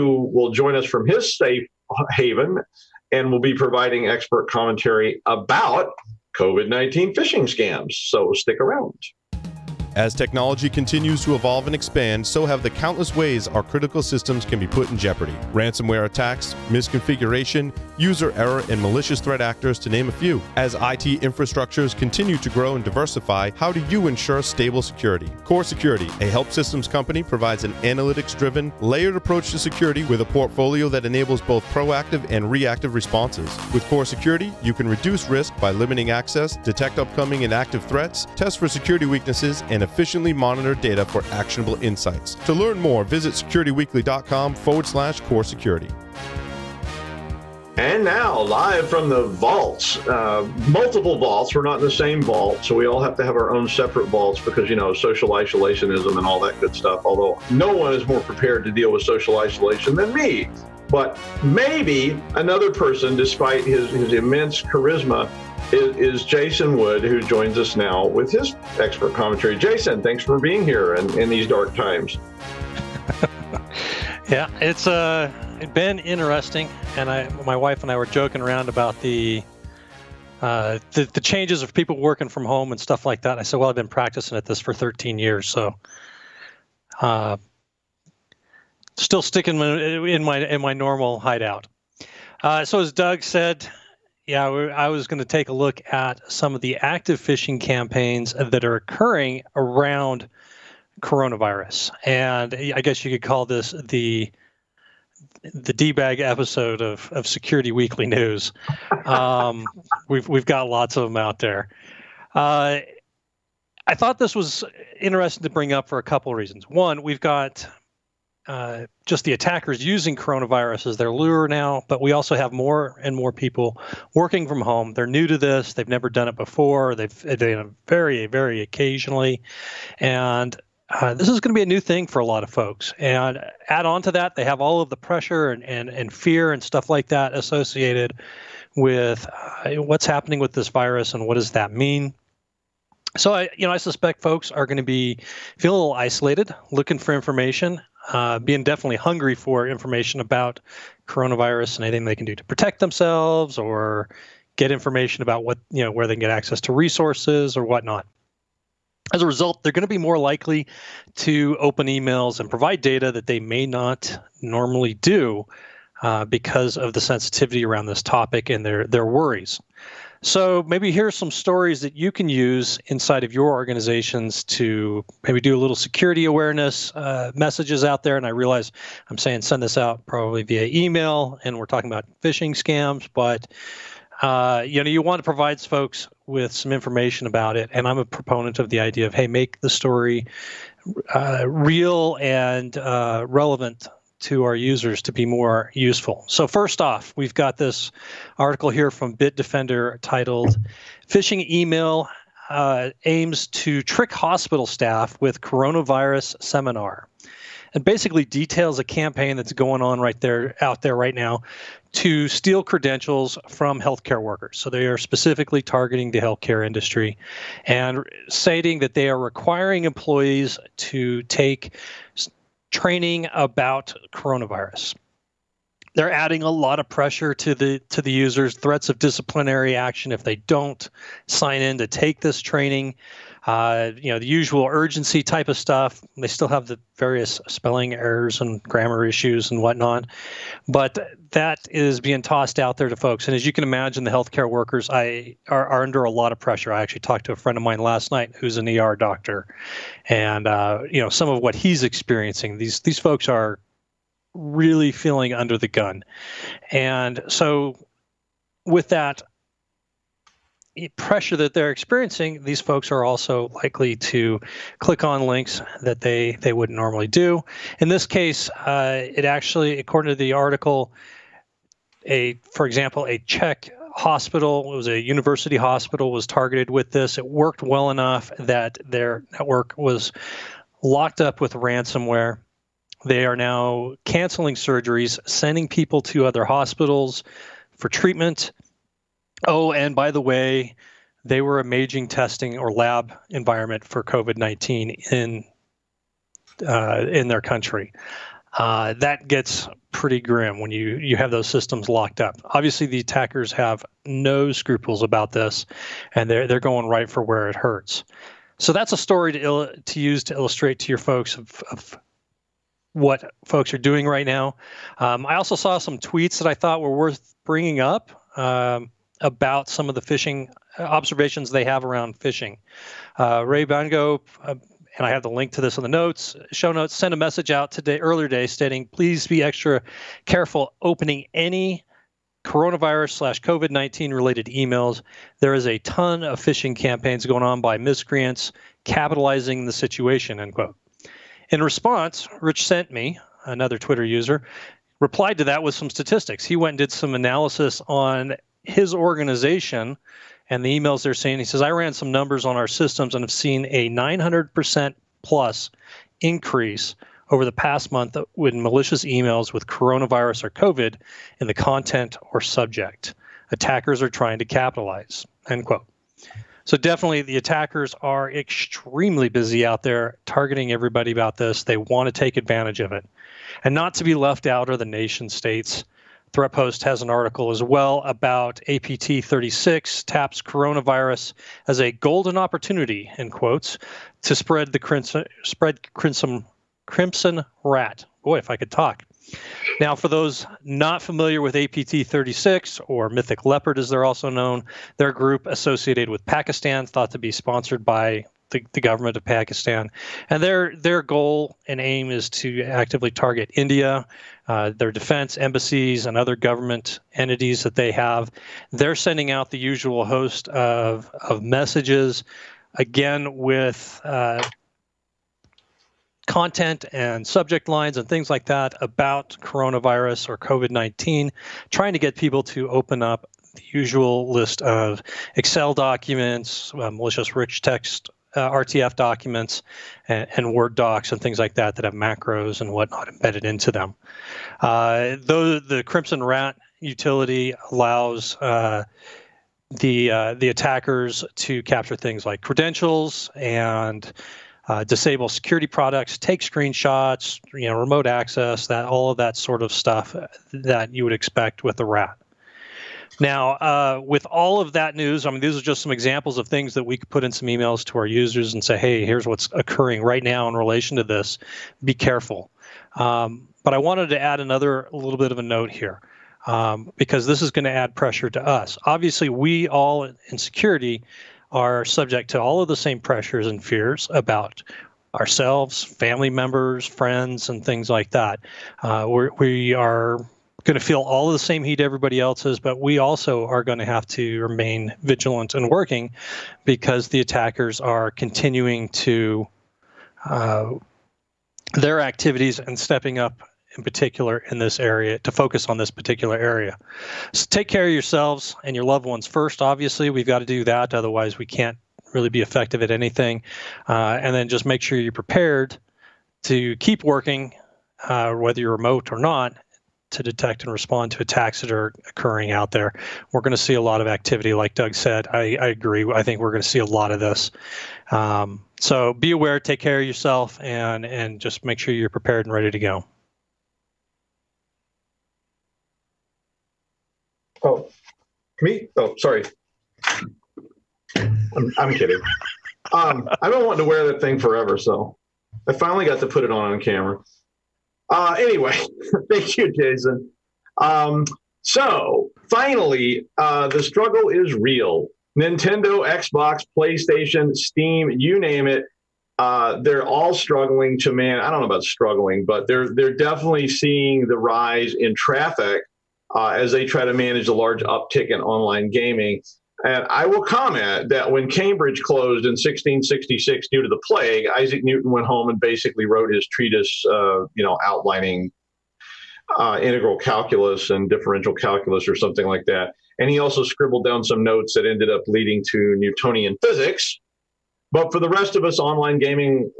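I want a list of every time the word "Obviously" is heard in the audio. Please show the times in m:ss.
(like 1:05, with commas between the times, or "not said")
5:02, 7:48, 8:19.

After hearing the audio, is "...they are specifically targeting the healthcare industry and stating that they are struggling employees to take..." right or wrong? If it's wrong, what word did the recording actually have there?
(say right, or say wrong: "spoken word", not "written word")
wrong: "requiring", not "struggling".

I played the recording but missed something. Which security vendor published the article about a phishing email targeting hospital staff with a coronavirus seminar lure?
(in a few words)
Bitdefender.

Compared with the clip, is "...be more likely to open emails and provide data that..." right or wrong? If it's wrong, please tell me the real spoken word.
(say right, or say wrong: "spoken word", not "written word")
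right.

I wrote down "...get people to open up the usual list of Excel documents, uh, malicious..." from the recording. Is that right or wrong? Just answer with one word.
right.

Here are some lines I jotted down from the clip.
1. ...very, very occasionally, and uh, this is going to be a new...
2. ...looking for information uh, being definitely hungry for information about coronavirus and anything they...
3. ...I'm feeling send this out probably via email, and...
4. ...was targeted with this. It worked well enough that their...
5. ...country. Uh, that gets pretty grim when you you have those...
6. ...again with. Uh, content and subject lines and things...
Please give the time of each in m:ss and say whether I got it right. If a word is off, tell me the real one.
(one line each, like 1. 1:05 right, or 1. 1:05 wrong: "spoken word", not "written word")
1. 2:07 right
2. 2:26 right
3. 2:59 wrong: "saying", not "feeling"
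4. 4:36 right
5. 4:57 right
6. 6:52 right.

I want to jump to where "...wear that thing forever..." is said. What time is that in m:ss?
8:53.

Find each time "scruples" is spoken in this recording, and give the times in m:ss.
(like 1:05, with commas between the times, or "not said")
5:04.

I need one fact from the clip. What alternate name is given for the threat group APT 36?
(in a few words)
Mythic Leopard.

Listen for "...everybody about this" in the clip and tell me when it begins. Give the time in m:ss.
6:10.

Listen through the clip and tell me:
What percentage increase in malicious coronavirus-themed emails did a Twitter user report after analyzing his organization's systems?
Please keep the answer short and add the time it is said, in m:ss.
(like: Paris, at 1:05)
900%, at 5:53.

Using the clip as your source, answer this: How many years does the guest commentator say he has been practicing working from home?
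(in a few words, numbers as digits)
13.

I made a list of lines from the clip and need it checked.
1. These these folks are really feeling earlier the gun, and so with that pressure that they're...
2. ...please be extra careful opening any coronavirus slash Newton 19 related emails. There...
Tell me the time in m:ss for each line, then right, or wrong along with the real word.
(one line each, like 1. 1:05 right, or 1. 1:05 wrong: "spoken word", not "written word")
1. 4:12 wrong: "under", not "earlier"
2. 5:28 wrong: "COVID", not "Newton".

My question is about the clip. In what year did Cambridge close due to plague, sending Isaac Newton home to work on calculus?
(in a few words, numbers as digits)
1666.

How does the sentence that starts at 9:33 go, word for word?
And he also scribbled down some notes that ended up leading to Newtonian physics.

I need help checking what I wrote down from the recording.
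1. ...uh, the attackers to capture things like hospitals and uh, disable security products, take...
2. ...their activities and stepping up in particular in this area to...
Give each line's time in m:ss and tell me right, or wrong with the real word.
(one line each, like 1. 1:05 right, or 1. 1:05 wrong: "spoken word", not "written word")
1. 7:20 wrong: "credentials", not "hospitals"
2. 8:11 right.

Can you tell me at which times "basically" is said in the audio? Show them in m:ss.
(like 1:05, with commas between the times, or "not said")
3:27, 9:25.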